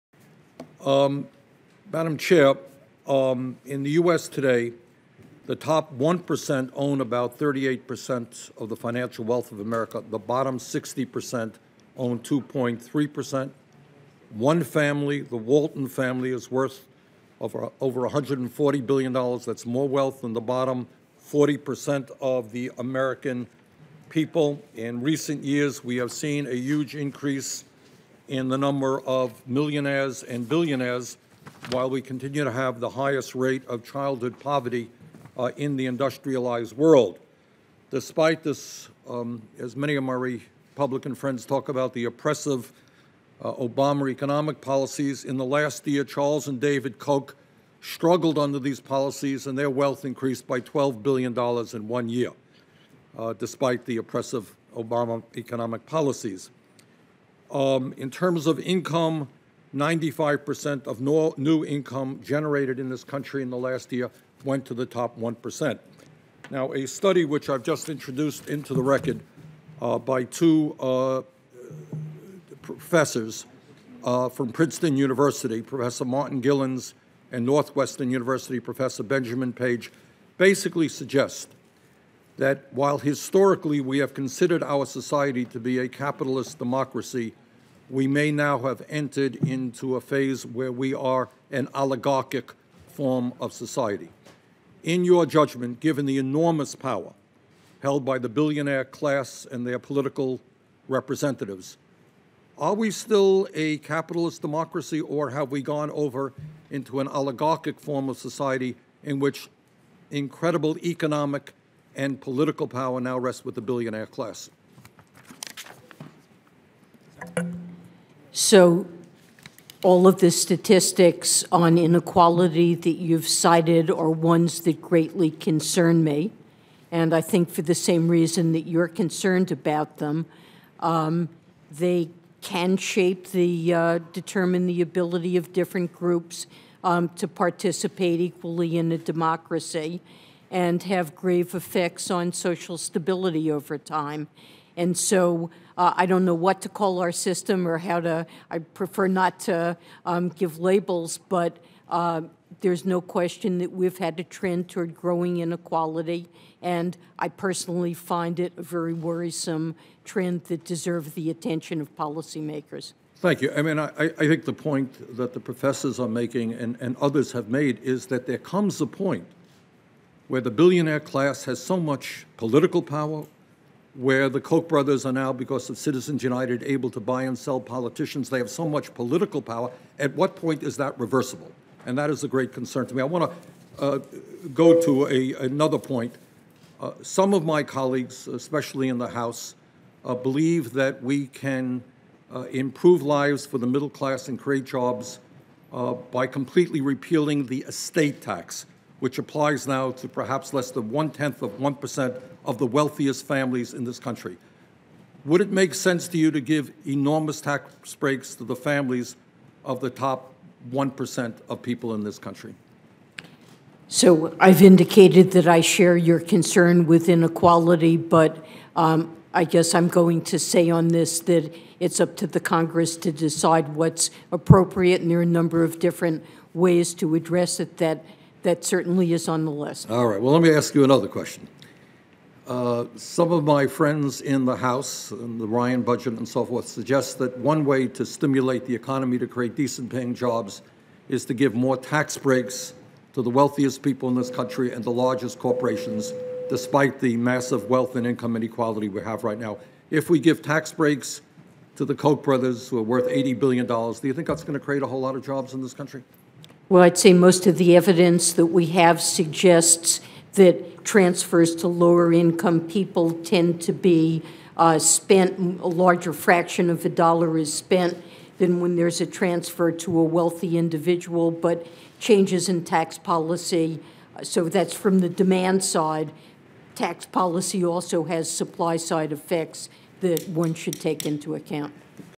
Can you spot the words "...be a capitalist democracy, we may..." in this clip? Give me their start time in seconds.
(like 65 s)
85 s.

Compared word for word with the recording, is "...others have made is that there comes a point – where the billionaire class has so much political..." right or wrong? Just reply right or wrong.
right.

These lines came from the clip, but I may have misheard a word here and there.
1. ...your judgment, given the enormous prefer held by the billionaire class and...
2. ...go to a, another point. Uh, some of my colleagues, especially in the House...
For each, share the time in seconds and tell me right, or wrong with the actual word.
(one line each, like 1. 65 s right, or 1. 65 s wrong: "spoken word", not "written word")
1. 95 s wrong: "power", not "prefer"
2. 184 s right.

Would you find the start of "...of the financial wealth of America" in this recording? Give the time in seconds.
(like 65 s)
8 s.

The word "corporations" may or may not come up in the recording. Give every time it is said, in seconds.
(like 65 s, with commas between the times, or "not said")
245 s.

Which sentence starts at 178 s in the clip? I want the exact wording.
They have so much political power.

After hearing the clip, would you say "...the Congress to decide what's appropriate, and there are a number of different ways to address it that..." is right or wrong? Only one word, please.
right.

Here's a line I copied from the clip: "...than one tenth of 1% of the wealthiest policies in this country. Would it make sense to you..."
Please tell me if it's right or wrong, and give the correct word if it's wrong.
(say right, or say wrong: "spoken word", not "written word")
wrong: "families", not "policies".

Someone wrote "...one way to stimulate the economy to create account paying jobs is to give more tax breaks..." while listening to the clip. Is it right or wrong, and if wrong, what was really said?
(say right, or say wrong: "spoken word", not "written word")
wrong: "decent", not "account".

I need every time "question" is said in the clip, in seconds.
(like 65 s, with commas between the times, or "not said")
152 s, 231 s.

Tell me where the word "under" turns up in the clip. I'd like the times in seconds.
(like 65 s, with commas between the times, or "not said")
48 s.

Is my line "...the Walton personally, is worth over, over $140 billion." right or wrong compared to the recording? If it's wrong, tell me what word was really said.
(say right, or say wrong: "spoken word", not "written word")
wrong: "family", not "personally".